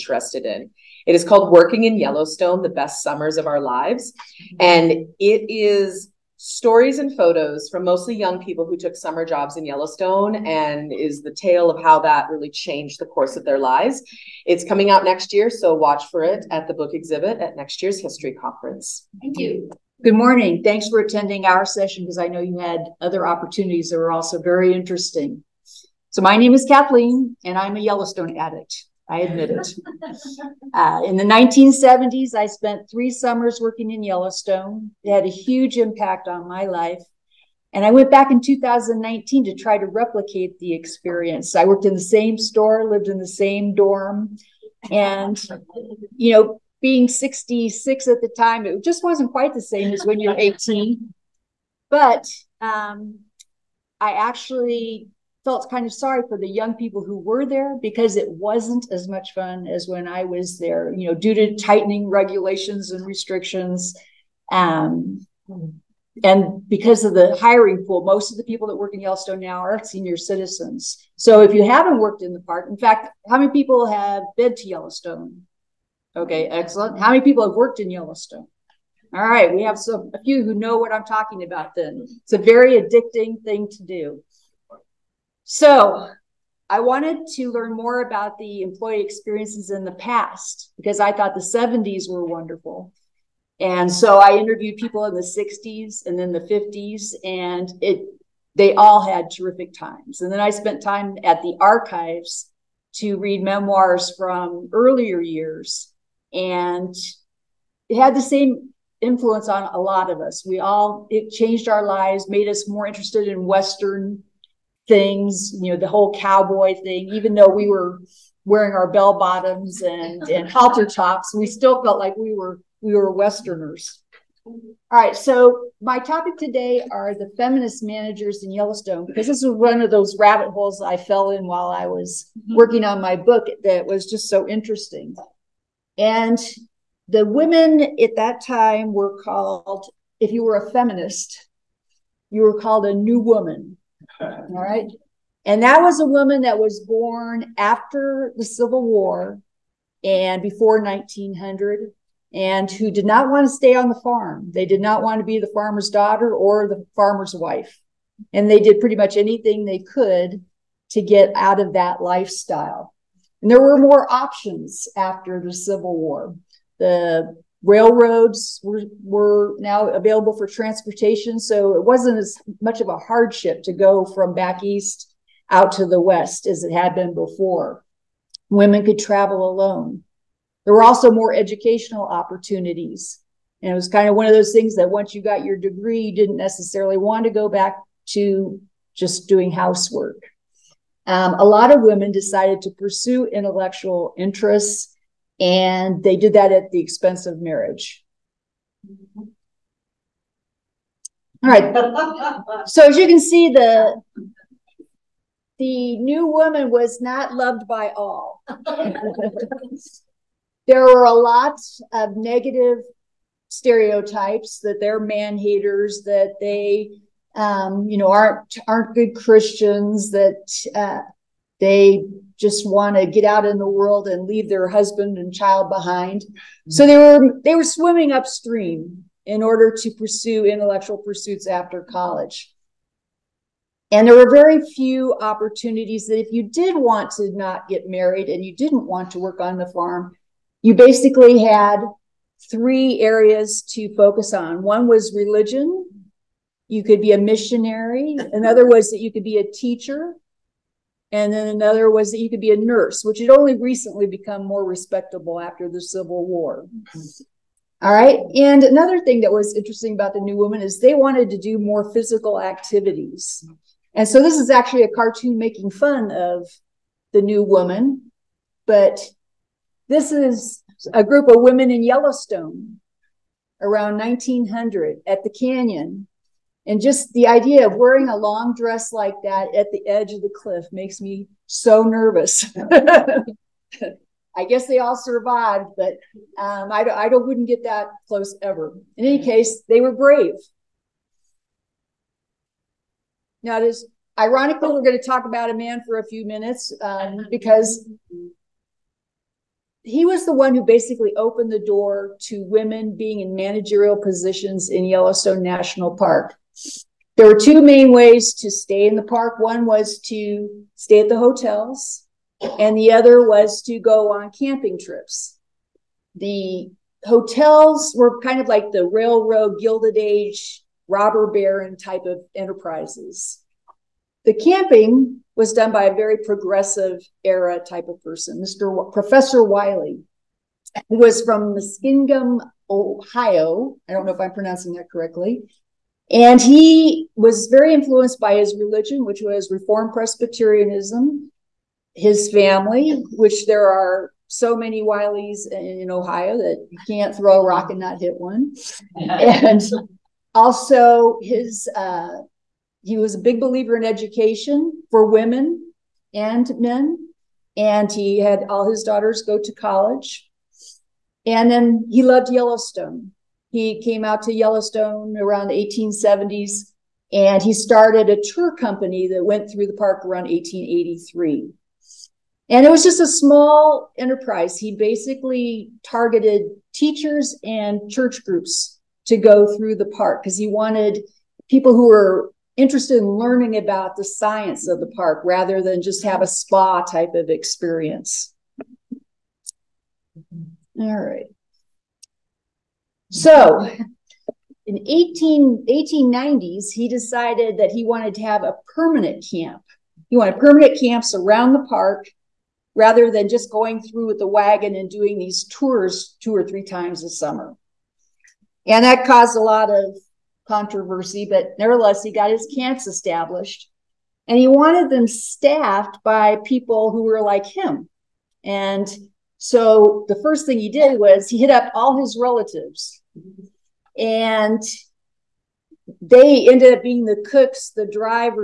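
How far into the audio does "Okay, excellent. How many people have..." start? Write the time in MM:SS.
01:16.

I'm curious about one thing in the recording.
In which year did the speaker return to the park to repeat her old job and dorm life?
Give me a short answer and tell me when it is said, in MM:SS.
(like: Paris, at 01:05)
2019, at 00:38.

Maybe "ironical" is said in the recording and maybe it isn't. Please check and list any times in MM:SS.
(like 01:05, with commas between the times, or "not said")
04:54.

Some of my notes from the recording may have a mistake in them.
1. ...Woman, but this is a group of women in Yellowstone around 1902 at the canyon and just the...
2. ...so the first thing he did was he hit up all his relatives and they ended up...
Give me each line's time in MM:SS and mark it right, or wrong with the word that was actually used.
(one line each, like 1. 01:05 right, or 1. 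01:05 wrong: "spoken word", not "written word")
1. 04:27 wrong: "1900", not "1902"
2. 06:59 right.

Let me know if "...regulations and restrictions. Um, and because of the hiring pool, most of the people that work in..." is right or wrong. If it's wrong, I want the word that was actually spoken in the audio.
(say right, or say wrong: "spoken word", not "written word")
right.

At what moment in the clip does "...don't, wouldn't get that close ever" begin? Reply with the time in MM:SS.
04:47.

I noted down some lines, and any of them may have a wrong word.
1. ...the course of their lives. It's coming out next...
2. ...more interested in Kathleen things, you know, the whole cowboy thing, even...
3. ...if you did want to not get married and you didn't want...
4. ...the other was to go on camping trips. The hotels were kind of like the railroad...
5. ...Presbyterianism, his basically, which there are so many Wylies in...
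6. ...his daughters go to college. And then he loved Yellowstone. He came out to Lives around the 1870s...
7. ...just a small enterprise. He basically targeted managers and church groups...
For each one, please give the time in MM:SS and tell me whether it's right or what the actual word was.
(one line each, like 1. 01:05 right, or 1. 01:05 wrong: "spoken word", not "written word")
1. 00:12 right
2. 01:52 wrong: "Western", not "Kathleen"
3. 03:56 right
4. 05:12 right
5. 05:39 wrong: "family", not "basically"
6. 05:58 wrong: "Yellowstone", not "Lives"
7. 06:12 wrong: "teachers", not "managers".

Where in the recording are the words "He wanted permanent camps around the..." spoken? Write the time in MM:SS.
06:40.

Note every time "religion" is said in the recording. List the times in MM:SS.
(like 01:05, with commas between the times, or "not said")
04:05, 05:38.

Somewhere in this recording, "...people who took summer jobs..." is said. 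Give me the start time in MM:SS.
00:08.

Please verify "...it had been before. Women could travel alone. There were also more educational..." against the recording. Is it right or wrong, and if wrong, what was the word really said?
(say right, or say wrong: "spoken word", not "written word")
right.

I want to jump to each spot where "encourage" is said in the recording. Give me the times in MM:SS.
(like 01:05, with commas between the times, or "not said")
not said.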